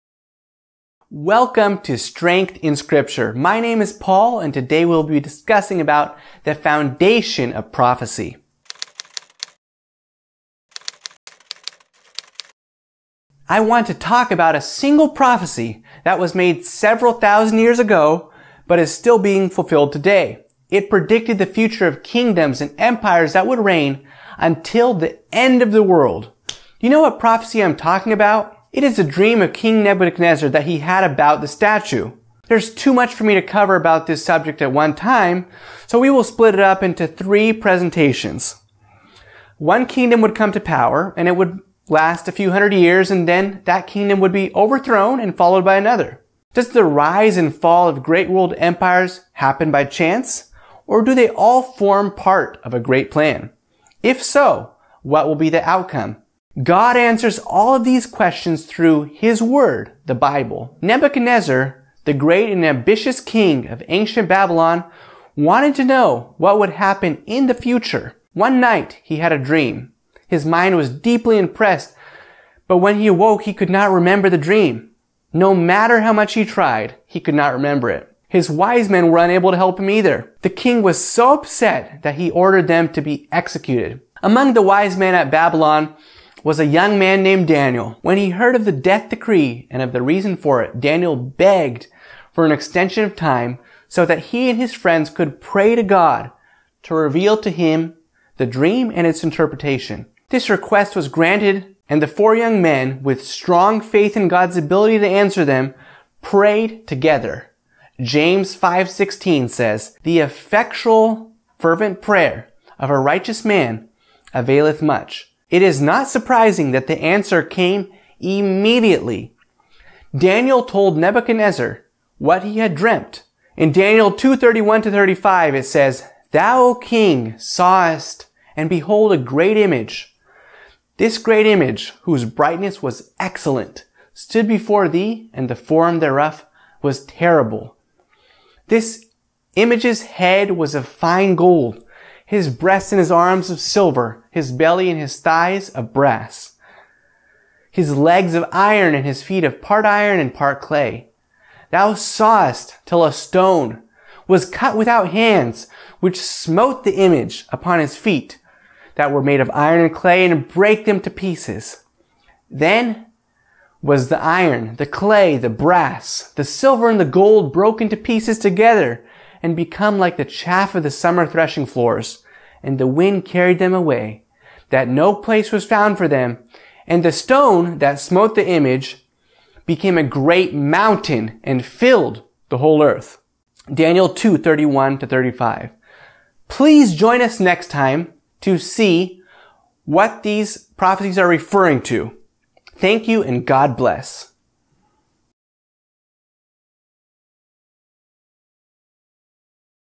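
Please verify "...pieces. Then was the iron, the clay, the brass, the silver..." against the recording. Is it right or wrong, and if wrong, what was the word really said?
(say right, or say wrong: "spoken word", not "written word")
right.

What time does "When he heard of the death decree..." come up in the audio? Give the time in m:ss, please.
1:28.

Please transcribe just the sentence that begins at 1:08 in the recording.
One night, he had a dream.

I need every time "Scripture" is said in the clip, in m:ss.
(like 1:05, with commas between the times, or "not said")
0:02.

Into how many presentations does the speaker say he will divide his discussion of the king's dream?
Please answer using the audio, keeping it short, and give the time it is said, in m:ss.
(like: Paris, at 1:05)
3, at 0:37.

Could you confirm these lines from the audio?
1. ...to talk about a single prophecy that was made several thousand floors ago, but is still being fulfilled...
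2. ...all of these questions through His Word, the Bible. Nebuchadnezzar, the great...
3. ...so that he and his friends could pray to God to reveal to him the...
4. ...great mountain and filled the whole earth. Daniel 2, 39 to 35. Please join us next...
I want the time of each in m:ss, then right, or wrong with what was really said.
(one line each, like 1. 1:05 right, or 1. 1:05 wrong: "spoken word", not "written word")
1. 0:13 wrong: "years", not "floors"
2. 0:57 right
3. 1:33 right
4. 3:00 wrong: "31", not "39".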